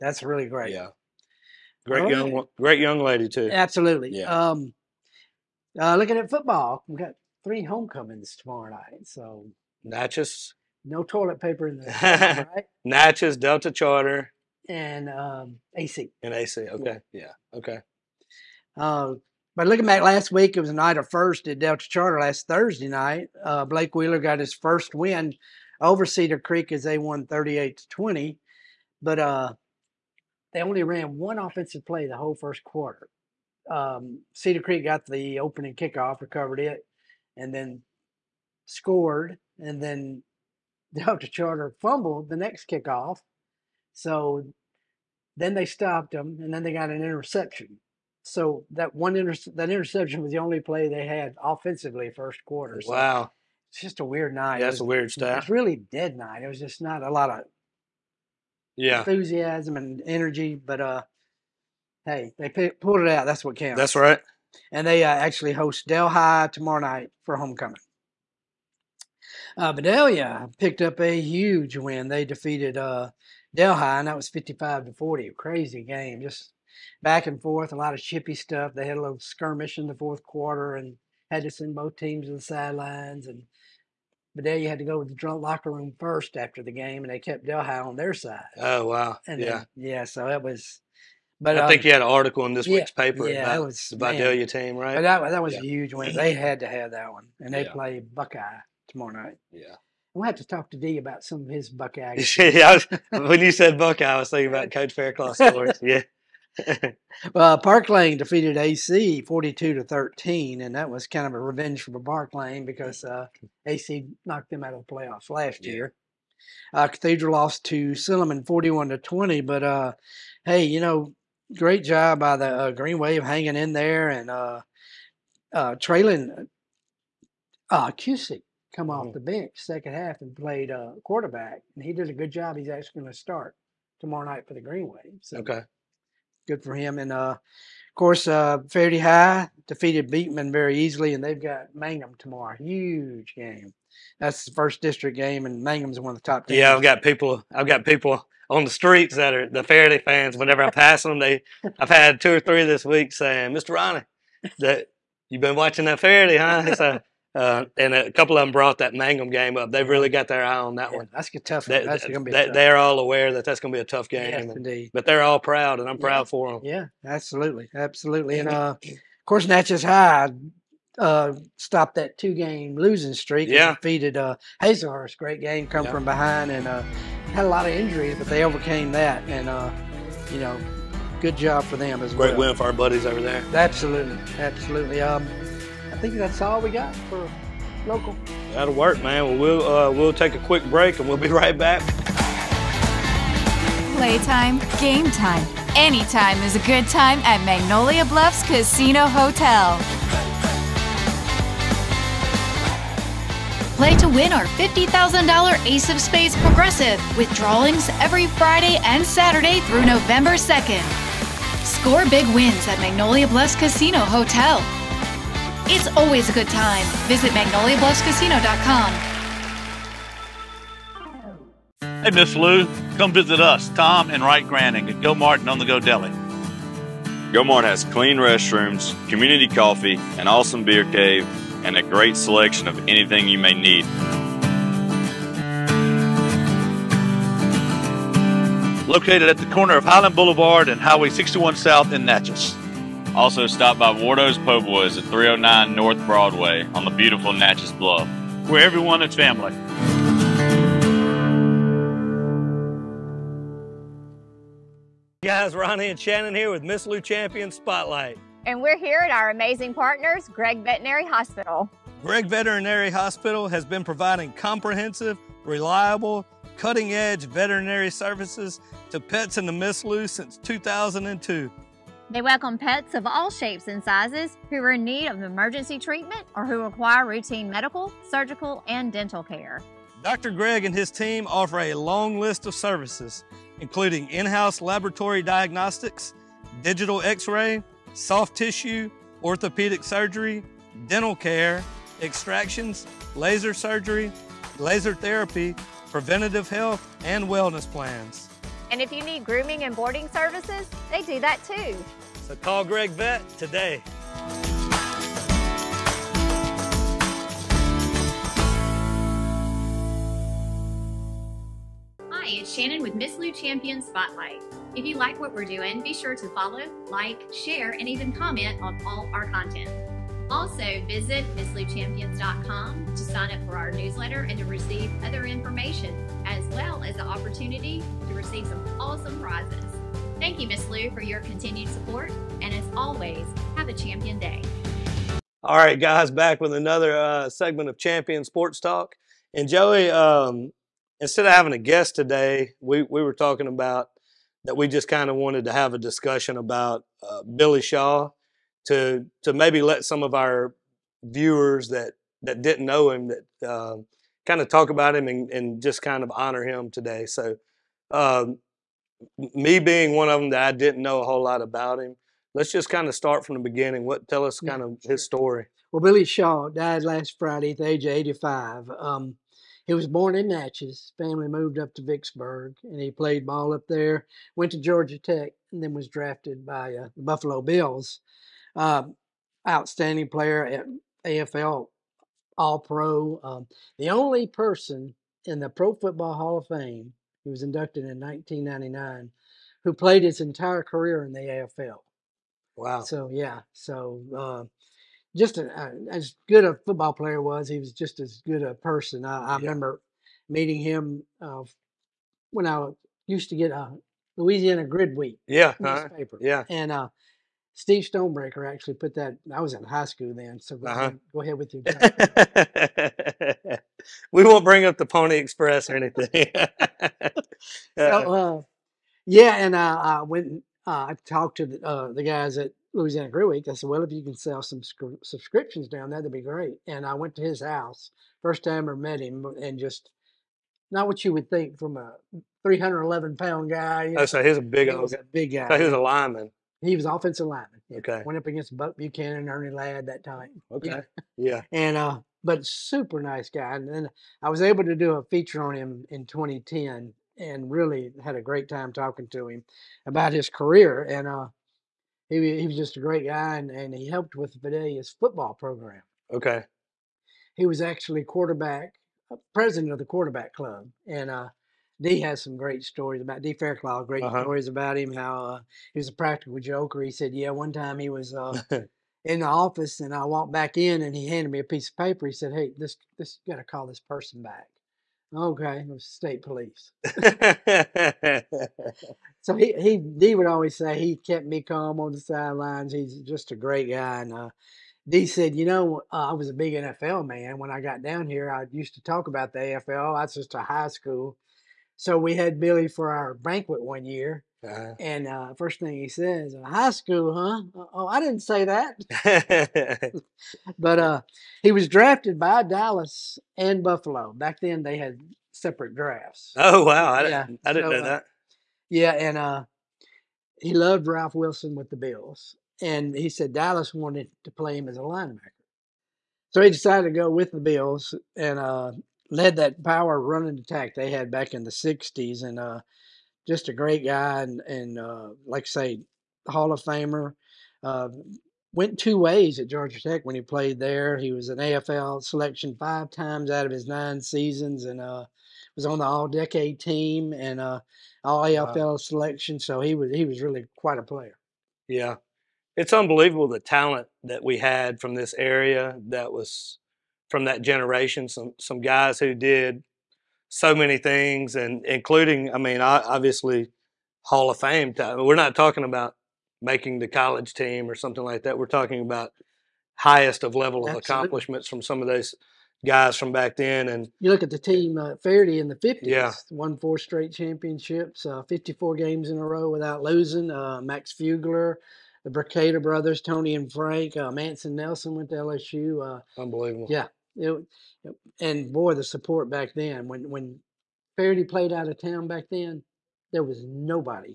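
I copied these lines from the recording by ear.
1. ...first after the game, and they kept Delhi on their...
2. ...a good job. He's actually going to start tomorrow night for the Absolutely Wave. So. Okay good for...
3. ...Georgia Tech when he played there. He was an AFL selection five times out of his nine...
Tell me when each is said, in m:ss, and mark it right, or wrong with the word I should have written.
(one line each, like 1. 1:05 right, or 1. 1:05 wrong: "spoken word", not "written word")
1. 1:25 right
2. 2:12 wrong: "Green", not "Absolutely"
3. 8:49 right.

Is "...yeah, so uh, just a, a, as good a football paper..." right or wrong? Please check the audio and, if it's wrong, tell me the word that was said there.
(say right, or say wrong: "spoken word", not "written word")
wrong: "player", not "paper".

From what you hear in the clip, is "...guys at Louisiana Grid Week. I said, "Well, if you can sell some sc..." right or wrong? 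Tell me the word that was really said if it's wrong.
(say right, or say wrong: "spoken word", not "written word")
right.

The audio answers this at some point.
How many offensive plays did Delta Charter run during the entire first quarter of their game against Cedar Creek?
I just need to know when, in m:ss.
0:31.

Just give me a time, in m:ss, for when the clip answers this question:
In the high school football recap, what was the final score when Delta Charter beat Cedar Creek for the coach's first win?
0:27.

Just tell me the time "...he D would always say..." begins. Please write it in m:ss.
7:59.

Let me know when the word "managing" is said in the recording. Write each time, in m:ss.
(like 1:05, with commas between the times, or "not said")
not said.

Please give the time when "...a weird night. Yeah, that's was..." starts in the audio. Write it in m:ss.
0:54.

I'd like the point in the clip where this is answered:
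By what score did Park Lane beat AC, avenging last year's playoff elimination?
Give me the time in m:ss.
1:49.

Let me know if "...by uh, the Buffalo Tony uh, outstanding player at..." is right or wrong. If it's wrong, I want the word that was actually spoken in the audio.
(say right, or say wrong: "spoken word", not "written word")
wrong: "Bills", not "Tony".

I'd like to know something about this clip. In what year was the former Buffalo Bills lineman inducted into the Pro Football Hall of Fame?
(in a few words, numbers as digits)
1999.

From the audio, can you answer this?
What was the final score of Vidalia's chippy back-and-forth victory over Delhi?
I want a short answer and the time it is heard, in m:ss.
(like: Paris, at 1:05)
55 to 40, at 1:14.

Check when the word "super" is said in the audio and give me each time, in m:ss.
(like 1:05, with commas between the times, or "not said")
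7:22.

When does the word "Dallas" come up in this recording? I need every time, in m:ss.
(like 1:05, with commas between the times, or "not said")
8:22, 8:33.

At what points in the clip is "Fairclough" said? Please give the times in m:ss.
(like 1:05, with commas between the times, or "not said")
1:44, 7:43.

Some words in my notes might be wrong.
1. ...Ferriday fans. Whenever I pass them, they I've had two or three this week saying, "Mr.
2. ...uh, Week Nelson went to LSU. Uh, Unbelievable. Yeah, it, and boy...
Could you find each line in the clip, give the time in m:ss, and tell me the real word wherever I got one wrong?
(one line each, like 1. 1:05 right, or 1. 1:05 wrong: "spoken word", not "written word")
1. 2:29 right
2. 9:33 wrong: "Manson", not "Week".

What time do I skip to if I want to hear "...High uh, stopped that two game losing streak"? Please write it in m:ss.
2:49.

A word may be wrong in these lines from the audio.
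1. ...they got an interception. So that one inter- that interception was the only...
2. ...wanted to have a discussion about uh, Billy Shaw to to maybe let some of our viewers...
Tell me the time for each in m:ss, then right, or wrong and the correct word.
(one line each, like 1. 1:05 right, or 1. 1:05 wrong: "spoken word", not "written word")
1. 0:46 right
2. 5:45 right.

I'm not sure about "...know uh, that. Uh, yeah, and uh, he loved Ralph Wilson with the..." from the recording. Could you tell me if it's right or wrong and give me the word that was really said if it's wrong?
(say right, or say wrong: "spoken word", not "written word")
right.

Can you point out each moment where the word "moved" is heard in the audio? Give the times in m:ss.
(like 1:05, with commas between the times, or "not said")
6:11.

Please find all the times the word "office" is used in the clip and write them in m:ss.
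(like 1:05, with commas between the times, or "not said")
7:49.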